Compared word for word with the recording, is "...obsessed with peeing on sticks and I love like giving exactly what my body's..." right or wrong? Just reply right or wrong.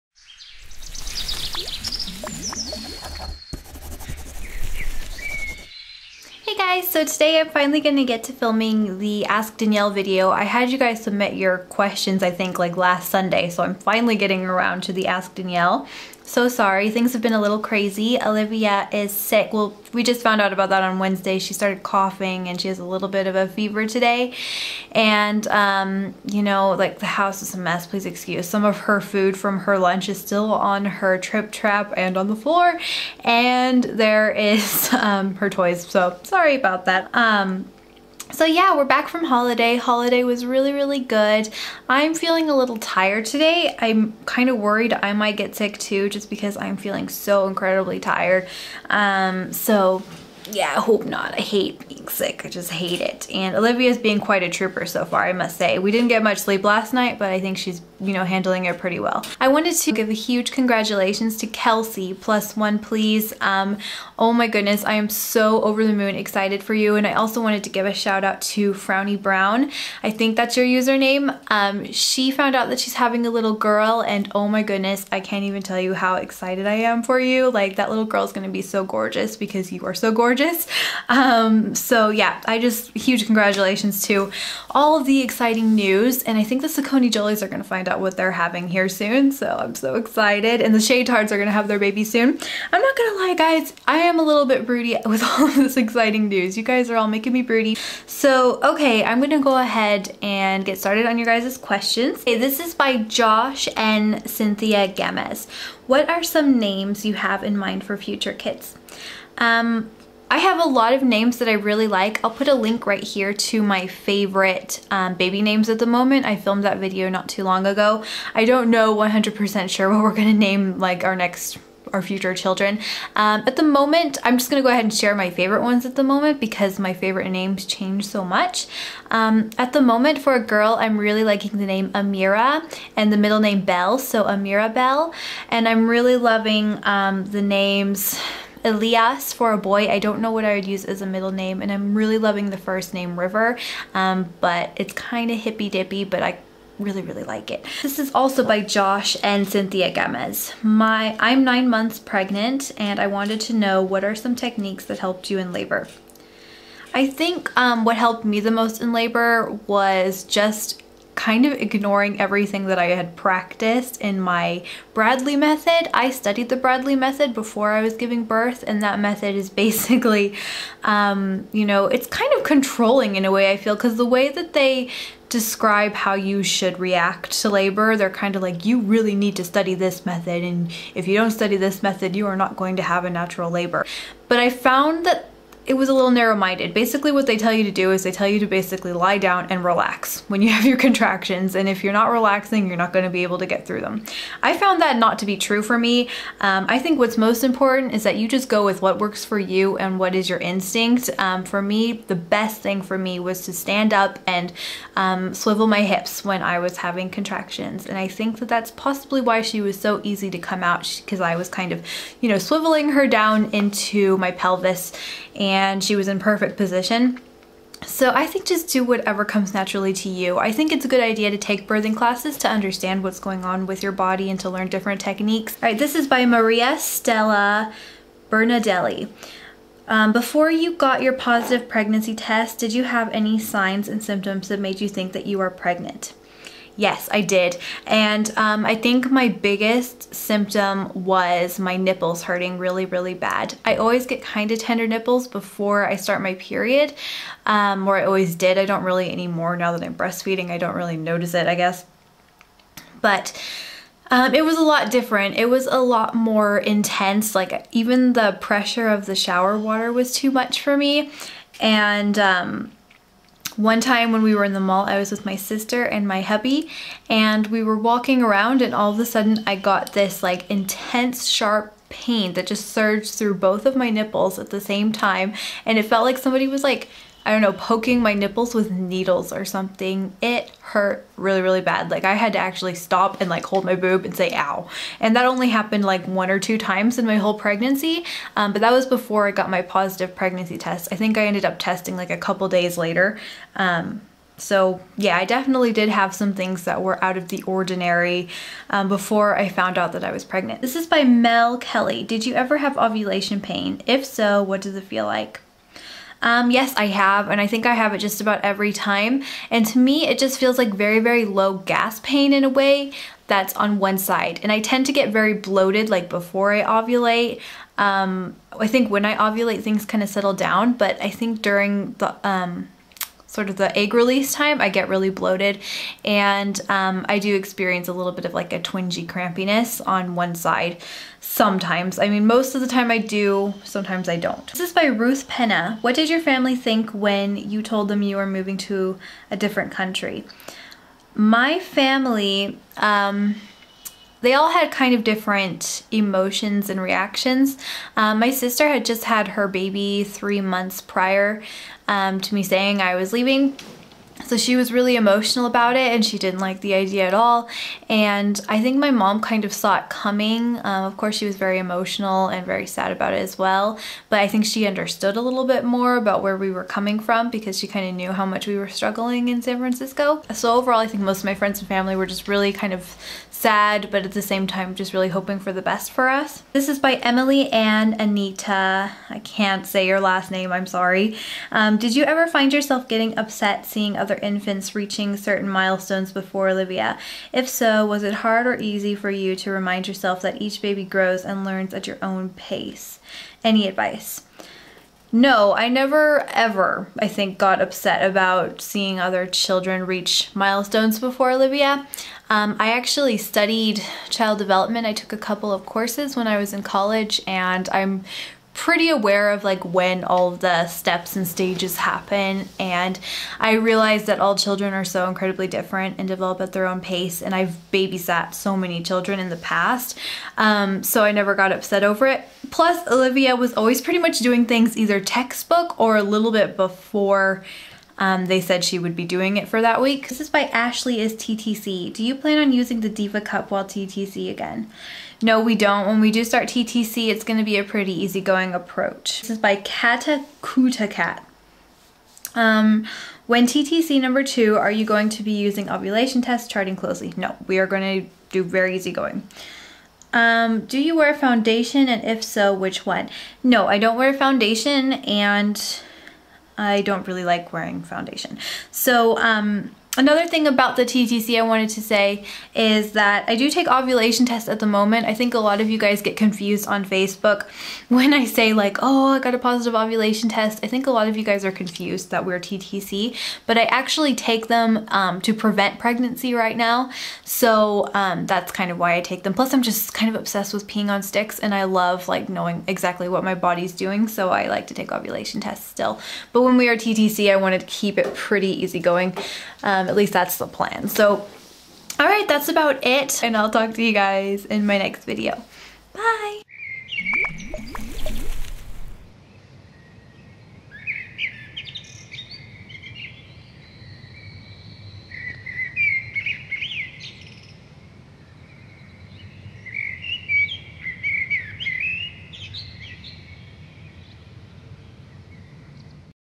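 wrong.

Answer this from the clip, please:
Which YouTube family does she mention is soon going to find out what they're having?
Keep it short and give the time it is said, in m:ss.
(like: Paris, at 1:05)
Saccone Jolys, at 1:26.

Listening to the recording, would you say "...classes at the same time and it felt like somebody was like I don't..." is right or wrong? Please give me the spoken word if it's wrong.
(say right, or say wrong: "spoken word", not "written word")
wrong: "nipples", not "classes".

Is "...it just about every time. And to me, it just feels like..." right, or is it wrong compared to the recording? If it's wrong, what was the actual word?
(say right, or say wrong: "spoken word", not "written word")
right.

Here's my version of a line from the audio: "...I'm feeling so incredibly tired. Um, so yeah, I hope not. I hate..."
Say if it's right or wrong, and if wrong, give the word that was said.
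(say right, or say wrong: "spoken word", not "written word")
right.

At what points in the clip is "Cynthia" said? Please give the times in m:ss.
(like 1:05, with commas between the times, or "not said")
1:44, 2:29.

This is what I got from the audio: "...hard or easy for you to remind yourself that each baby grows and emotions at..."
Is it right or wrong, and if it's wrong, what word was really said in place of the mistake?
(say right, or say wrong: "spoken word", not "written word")
wrong: "learns", not "emotions".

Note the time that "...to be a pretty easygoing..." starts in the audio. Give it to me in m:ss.
7:17.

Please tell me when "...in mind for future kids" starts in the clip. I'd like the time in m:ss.
1:47.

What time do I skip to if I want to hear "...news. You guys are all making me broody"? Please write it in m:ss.
1:36.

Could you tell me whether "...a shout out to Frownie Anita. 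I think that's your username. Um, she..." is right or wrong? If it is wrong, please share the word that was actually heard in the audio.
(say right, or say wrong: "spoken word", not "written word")
wrong: "Brown", not "Anita".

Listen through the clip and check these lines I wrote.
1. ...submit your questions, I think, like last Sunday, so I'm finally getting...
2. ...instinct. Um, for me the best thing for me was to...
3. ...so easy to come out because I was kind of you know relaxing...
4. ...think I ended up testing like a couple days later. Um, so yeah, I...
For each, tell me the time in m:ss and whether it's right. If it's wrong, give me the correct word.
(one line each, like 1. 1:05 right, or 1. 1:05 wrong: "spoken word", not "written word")
1. 0:11 right
2. 3:20 right
3. 3:29 wrong: "swiveling", not "relaxing"
4. 4:50 right.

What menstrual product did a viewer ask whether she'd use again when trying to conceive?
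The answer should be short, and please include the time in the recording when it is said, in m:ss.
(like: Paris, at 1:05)
Diva Cup, at 7:12.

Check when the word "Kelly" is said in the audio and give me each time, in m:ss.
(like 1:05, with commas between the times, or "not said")
5:01.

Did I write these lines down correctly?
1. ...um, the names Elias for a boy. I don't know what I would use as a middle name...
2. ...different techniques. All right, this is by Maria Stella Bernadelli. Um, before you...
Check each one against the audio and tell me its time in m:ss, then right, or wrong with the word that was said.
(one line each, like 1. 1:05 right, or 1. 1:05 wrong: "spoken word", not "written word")
1. 2:16 right
2. 3:44 right.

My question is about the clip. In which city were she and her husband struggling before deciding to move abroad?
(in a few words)
San Francisco.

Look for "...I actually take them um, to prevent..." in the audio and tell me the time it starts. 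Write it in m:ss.
7:53.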